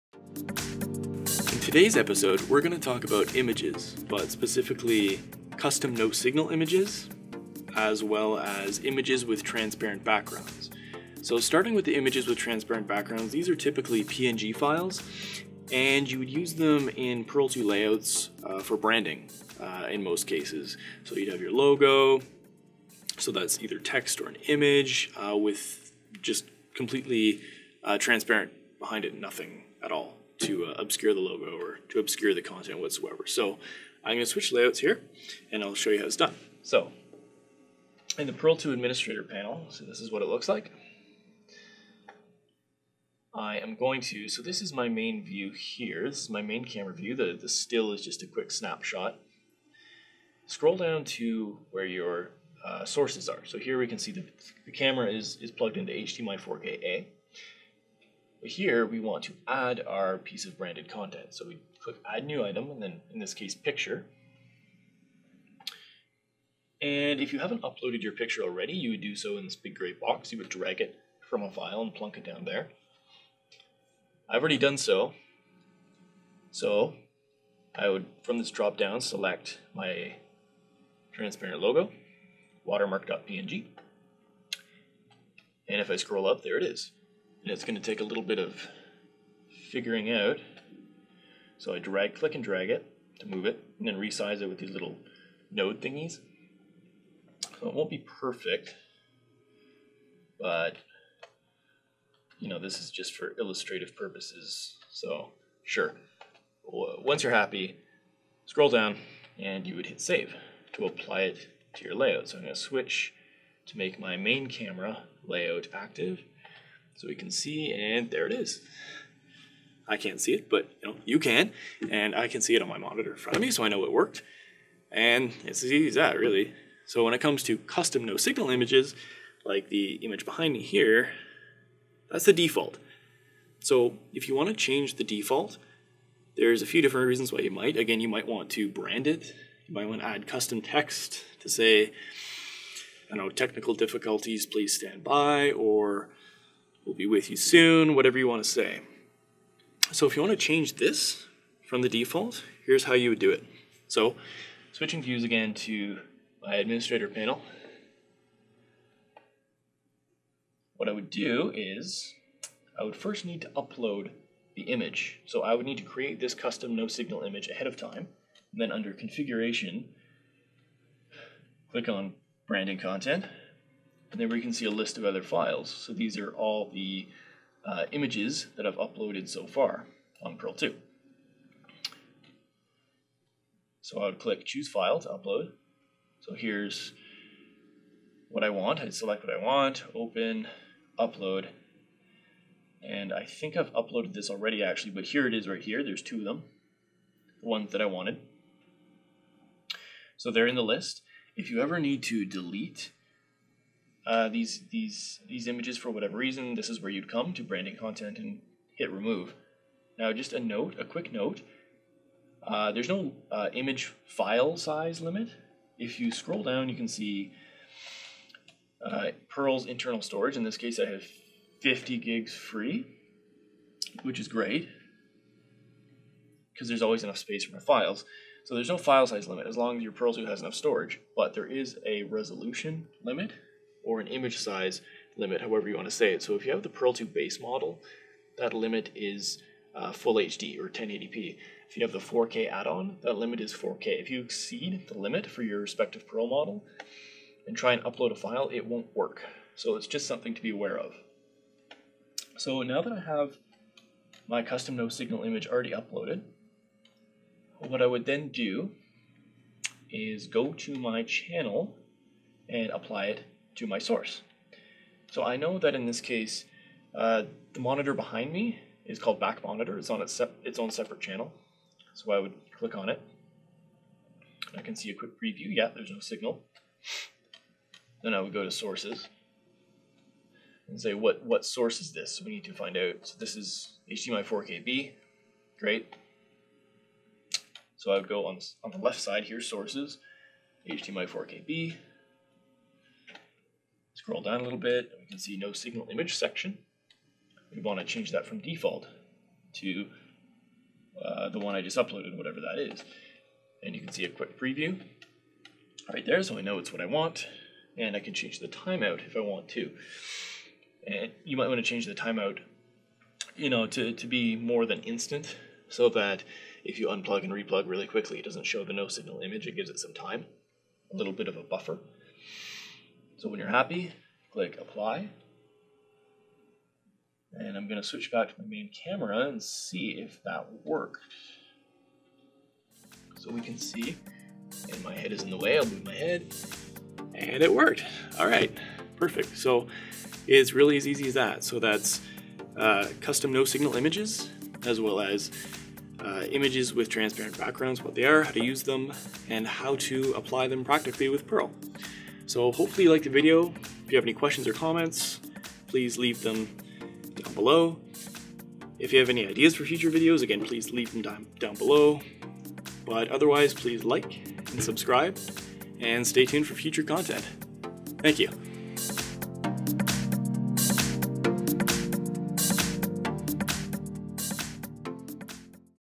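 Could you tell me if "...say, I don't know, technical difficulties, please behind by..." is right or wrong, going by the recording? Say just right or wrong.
wrong.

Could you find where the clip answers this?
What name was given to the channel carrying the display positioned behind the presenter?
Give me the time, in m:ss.
4:29.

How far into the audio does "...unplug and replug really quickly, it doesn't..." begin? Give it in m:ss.
5:16.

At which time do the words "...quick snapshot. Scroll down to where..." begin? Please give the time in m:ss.
0:48.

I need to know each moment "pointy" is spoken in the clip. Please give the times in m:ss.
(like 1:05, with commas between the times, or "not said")
not said.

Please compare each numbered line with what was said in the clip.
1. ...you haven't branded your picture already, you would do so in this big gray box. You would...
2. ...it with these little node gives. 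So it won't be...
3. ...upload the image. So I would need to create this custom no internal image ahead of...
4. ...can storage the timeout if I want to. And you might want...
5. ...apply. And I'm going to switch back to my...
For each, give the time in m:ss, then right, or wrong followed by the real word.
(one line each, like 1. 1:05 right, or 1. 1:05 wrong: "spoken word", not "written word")
1. 1:07 wrong: "uploaded", not "branded"
2. 1:34 wrong: "thingies", not "gives"
3. 2:43 wrong: "signal", not "internal"
4. 5:07 wrong: "change", not "storage"
5. 5:24 right.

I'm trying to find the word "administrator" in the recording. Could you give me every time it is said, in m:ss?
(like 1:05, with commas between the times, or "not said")
0:38, 2:36.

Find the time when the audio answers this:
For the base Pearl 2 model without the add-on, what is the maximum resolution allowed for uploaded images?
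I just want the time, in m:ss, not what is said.
4:00.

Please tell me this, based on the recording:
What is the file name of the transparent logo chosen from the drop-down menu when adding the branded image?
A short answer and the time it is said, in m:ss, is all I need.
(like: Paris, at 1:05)
watermark.png, at 1:22.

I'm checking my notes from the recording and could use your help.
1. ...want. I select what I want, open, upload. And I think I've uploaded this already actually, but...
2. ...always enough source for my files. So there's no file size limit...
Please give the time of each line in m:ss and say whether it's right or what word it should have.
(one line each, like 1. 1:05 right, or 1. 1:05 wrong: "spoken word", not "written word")
1. 3:08 right
2. 3:46 wrong: "space", not "source".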